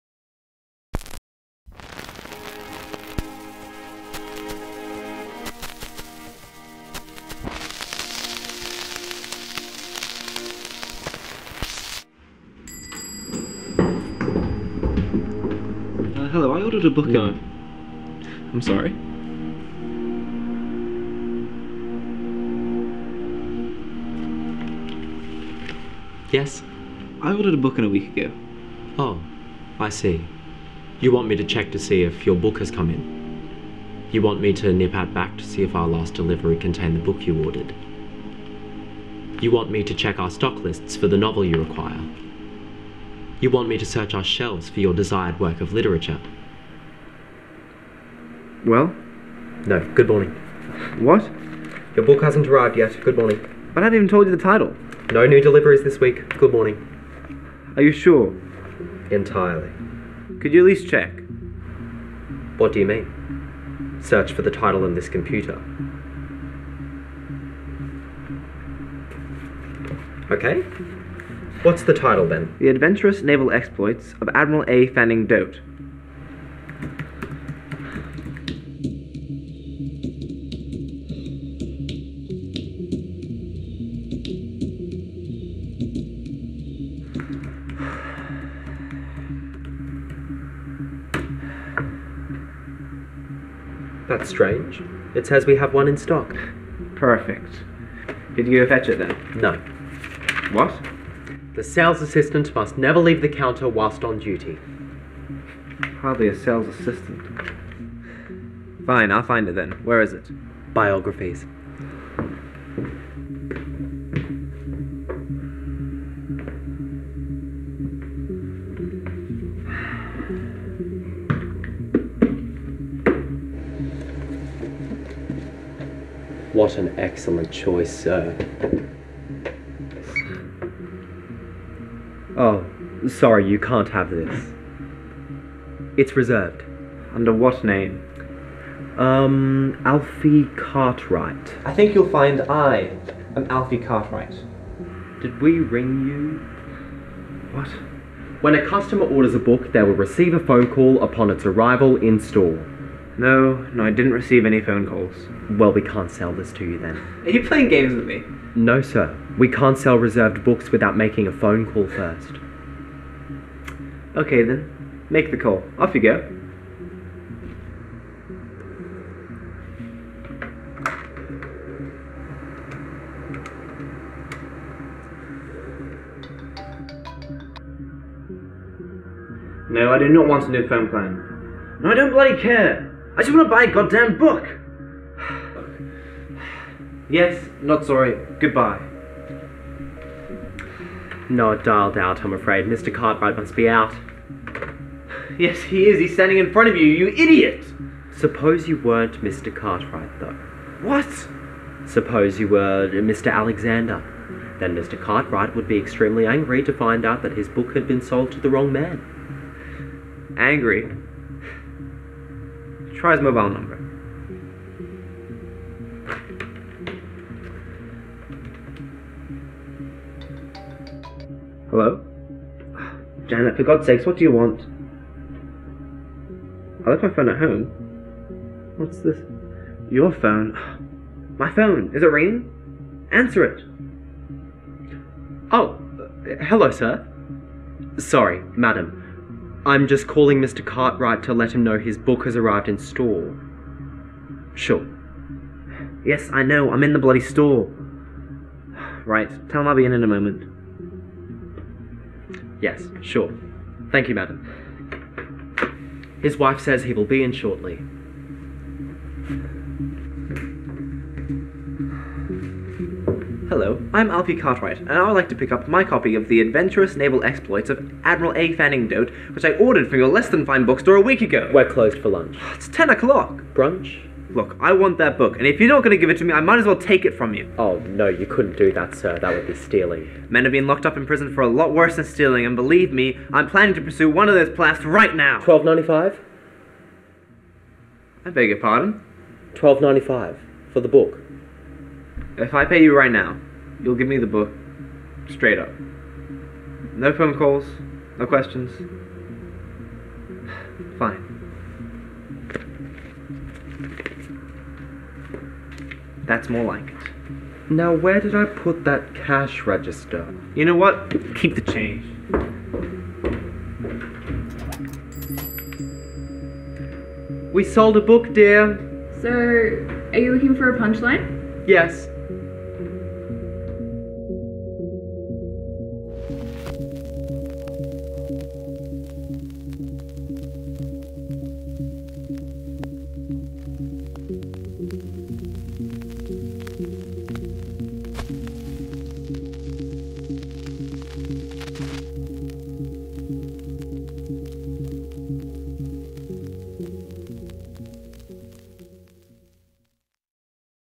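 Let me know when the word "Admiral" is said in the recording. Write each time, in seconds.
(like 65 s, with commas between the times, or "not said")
74 s, 268 s.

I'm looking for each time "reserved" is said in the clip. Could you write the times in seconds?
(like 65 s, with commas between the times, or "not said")
136 s, 159 s.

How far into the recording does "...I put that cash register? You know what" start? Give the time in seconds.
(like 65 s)
308 s.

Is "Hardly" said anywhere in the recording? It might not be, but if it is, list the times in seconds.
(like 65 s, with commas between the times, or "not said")
105 s.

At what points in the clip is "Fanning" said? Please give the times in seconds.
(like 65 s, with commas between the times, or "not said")
74 s, 268 s.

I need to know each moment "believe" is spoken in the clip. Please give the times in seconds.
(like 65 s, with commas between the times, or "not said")
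282 s.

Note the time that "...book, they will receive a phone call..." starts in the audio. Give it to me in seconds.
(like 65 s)
149 s.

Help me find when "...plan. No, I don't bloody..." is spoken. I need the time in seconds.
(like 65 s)
180 s.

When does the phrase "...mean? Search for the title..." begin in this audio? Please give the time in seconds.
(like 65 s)
62 s.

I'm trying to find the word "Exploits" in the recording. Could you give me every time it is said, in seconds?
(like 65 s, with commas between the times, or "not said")
73 s, 267 s.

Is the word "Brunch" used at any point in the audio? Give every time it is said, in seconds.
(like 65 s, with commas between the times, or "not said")
273 s.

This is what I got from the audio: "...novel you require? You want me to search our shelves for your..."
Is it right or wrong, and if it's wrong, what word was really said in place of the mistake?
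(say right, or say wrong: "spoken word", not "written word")
right.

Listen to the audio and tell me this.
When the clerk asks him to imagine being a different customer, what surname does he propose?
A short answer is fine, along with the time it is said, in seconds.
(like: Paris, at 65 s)
Alexander, at 202 s.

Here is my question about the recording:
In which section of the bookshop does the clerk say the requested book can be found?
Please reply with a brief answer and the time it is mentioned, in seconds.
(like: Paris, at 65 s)
Biographies, at 110 s.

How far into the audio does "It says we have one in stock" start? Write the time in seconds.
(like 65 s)
95 s.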